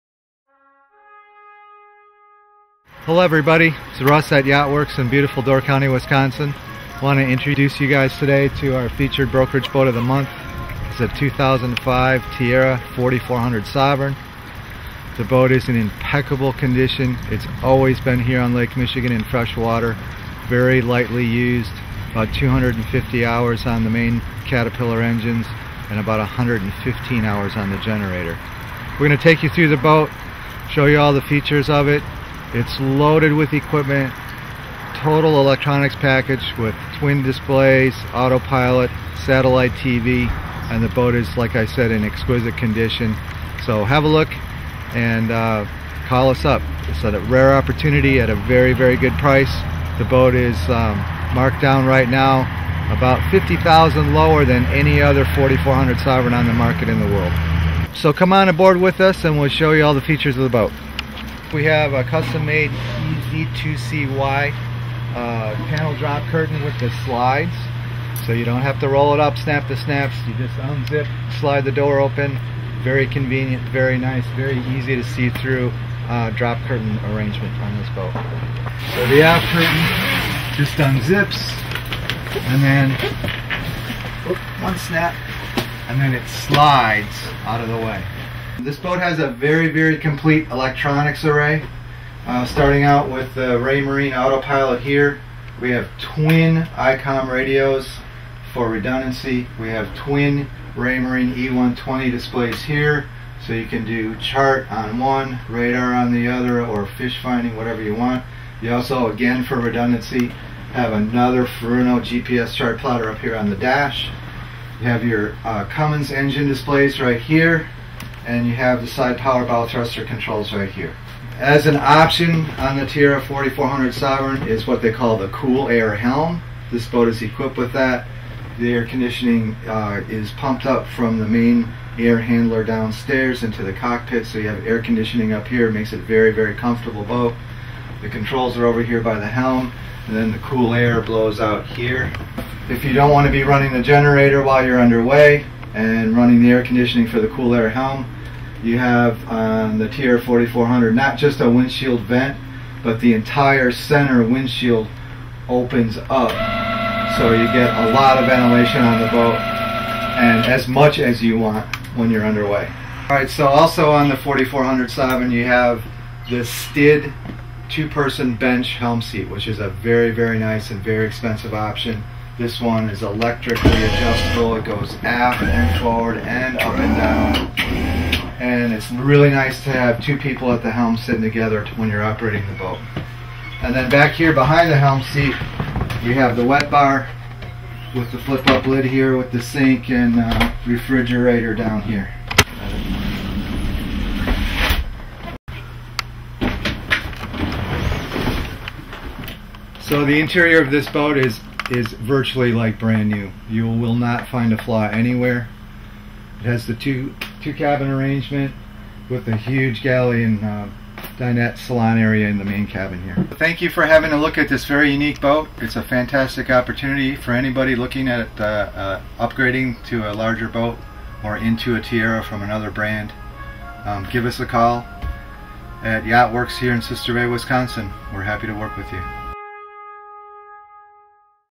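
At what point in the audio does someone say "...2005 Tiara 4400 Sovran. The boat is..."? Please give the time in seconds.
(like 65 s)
11 s.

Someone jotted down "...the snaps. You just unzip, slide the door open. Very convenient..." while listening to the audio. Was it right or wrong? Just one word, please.
right.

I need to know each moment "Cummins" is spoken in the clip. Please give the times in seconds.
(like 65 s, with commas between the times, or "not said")
115 s.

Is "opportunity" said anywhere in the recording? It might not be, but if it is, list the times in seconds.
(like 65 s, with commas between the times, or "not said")
47 s, 216 s.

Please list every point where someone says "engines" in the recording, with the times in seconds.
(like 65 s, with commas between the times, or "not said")
25 s, 116 s.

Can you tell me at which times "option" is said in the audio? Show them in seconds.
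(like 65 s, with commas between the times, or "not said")
121 s, 171 s.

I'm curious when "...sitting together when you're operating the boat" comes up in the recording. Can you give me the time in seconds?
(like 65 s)
180 s.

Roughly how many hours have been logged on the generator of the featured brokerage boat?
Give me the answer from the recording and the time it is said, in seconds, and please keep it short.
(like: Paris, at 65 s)
115, at 26 s.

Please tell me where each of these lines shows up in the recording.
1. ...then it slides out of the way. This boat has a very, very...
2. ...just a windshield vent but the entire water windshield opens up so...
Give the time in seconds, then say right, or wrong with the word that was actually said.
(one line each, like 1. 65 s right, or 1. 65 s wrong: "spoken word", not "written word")
1. 85 s right
2. 151 s wrong: "center", not "water".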